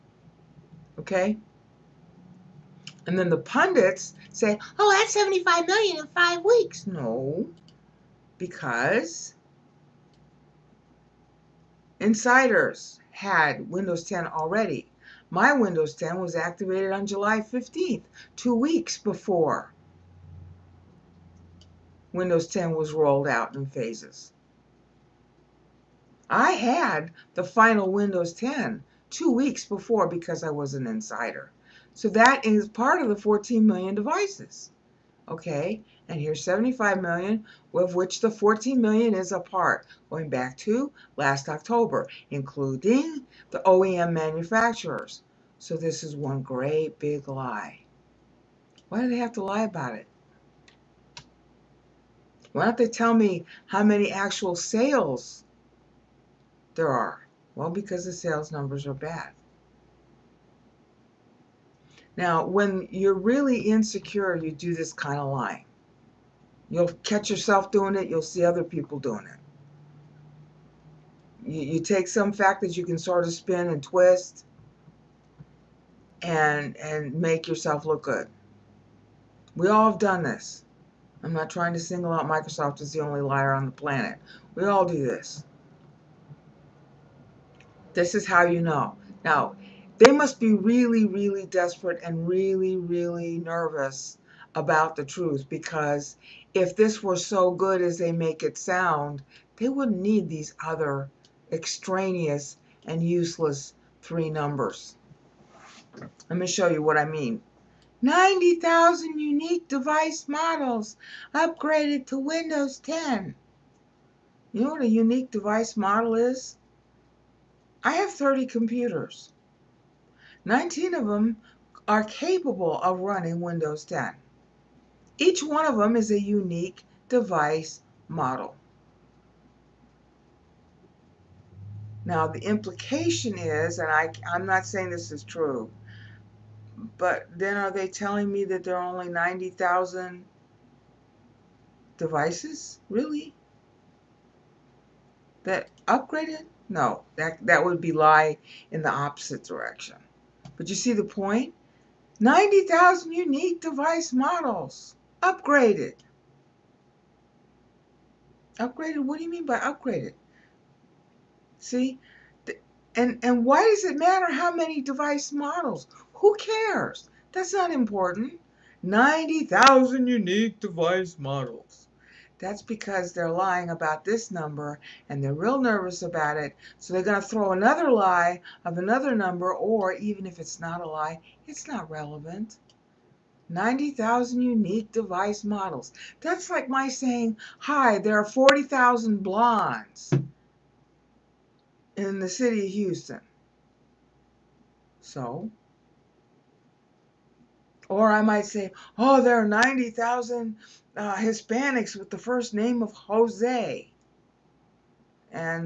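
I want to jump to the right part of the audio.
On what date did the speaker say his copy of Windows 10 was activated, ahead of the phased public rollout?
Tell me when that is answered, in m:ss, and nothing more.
0:17.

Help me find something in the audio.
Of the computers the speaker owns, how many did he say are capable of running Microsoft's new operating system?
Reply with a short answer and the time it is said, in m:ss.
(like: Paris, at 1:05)
19, at 2:00.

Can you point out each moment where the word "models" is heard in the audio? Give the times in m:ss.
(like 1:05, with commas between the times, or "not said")
1:50, 1:55, 2:08, 2:34, 2:45, 2:51, 3:05.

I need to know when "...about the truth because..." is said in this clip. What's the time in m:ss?
1:34.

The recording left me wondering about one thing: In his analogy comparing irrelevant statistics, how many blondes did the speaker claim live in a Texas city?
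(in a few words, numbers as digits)
40,000.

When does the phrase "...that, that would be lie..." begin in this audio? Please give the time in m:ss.
2:27.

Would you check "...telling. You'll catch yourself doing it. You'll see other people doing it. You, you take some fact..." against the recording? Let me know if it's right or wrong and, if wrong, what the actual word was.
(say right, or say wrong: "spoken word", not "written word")
wrong: "lying", not "telling".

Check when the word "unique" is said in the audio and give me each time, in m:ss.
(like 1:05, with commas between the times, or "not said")
1:49, 1:54, 2:06, 2:33, 2:50, 3:04.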